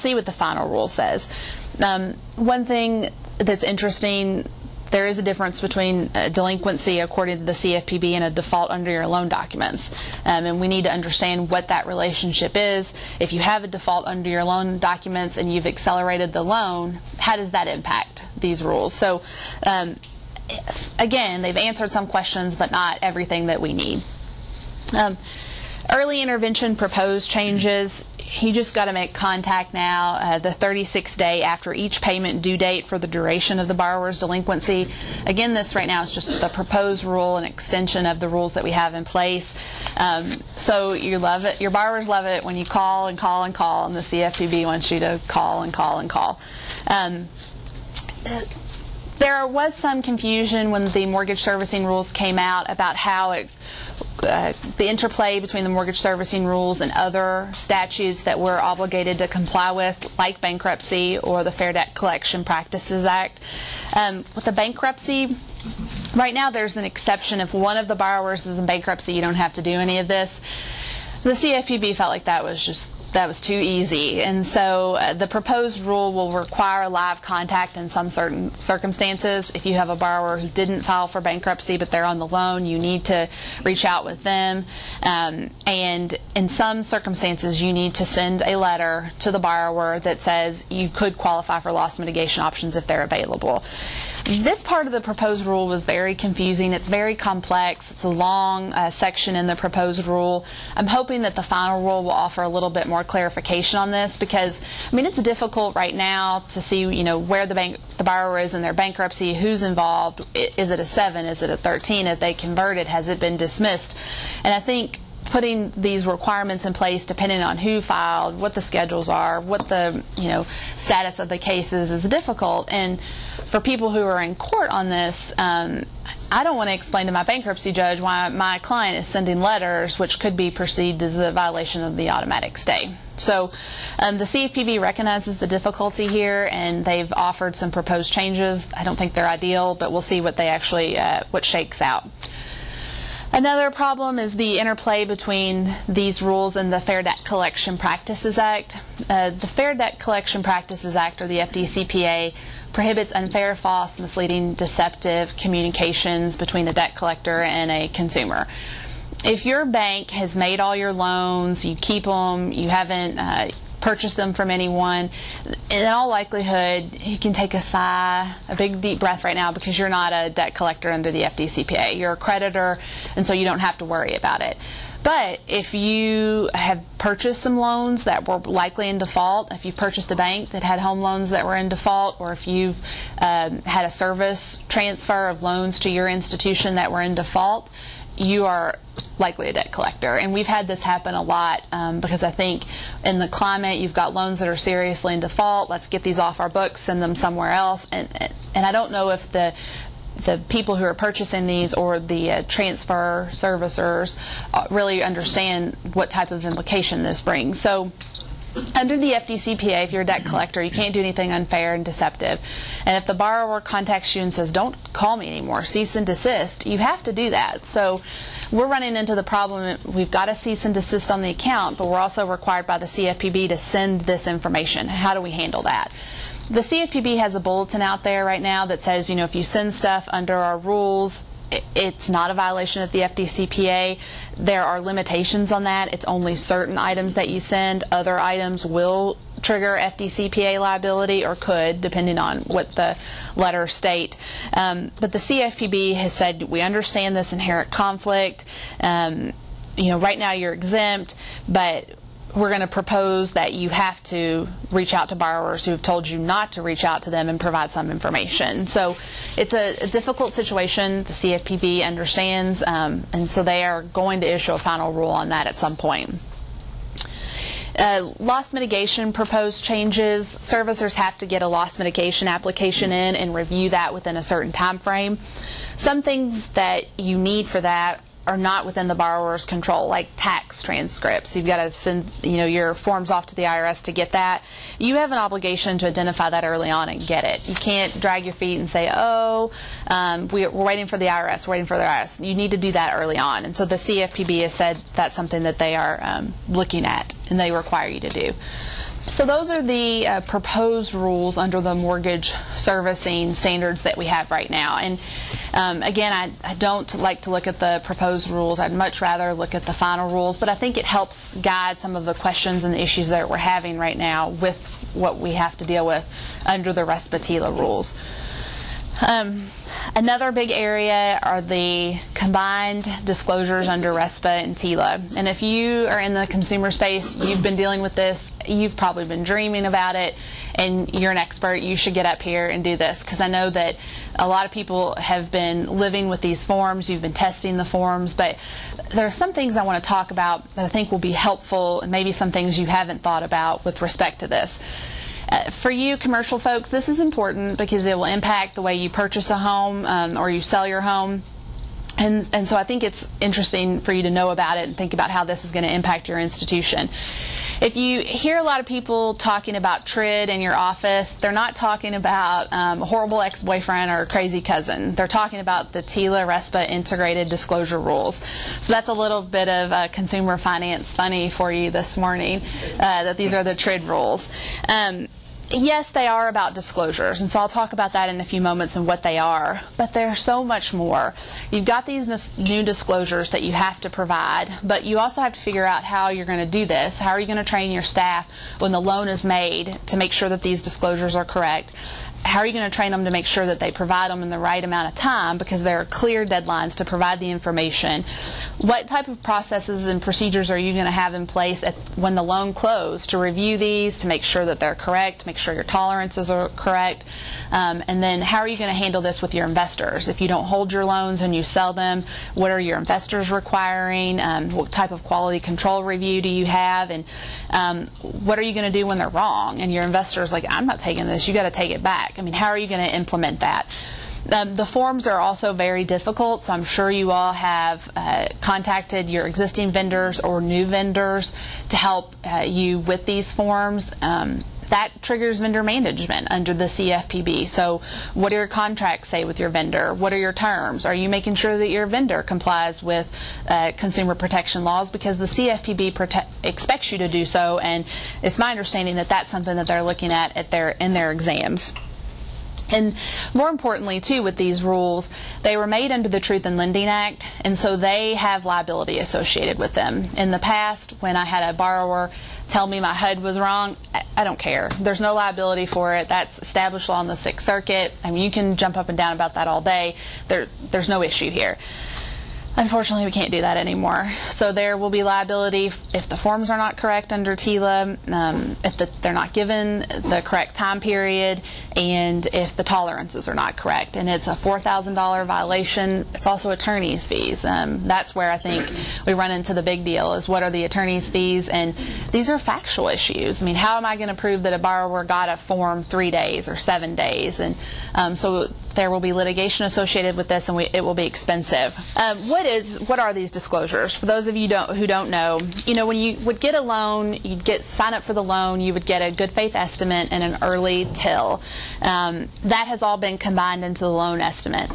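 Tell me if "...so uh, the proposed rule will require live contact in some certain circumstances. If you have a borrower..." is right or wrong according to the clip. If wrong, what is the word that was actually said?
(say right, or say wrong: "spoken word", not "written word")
right.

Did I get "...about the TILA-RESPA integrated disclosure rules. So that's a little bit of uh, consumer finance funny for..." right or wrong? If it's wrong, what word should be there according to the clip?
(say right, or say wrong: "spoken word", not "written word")
right.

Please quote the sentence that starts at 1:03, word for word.
Um, with the bankruptcy, right now there's an exception.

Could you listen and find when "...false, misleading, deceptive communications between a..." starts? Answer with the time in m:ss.
2:33.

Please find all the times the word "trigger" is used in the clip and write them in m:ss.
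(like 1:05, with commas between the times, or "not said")
3:59, 7:15.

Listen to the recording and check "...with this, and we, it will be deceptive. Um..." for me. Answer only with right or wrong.
wrong.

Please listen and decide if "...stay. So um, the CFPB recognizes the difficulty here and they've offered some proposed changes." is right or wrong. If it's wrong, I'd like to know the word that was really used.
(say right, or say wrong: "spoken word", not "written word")
right.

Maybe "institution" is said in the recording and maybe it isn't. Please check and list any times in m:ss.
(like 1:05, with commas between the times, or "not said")
3:06, 5:56.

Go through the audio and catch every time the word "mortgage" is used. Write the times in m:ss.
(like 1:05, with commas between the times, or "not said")
0:51, 0:55, 5:01.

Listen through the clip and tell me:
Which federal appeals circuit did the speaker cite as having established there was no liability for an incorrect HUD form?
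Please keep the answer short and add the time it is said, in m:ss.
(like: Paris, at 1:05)
Sixth Circuit, at 7:47.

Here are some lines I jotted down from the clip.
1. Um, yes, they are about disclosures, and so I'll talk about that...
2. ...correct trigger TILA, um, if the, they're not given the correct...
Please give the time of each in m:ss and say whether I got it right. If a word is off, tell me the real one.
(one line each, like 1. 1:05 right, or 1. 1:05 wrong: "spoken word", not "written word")
1. 6:14 right
2. 7:56 wrong: "under", not "trigger".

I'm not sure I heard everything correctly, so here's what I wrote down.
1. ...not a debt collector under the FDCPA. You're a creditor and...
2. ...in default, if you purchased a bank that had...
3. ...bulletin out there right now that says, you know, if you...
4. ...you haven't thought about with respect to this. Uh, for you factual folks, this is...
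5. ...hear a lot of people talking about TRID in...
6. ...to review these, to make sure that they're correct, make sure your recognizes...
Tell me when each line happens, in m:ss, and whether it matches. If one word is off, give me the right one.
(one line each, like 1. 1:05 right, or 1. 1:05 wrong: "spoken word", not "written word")
1. 2:49 right
2. 2:58 right
3. 3:47 right
4. 5:42 wrong: "commercial", not "factual"
5. 5:58 right
6. 6:43 wrong: "tolerances", not "recognizes".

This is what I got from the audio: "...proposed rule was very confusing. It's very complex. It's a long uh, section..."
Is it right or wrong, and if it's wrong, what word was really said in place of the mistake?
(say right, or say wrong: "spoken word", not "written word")
right.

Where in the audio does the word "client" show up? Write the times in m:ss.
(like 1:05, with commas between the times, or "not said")
2:08.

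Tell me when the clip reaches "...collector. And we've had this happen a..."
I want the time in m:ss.
3:09.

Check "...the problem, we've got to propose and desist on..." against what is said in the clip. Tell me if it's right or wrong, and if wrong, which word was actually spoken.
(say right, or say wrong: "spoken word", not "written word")
wrong: "cease", not "propose".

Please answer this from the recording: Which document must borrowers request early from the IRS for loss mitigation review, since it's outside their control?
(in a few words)
Tax transcripts.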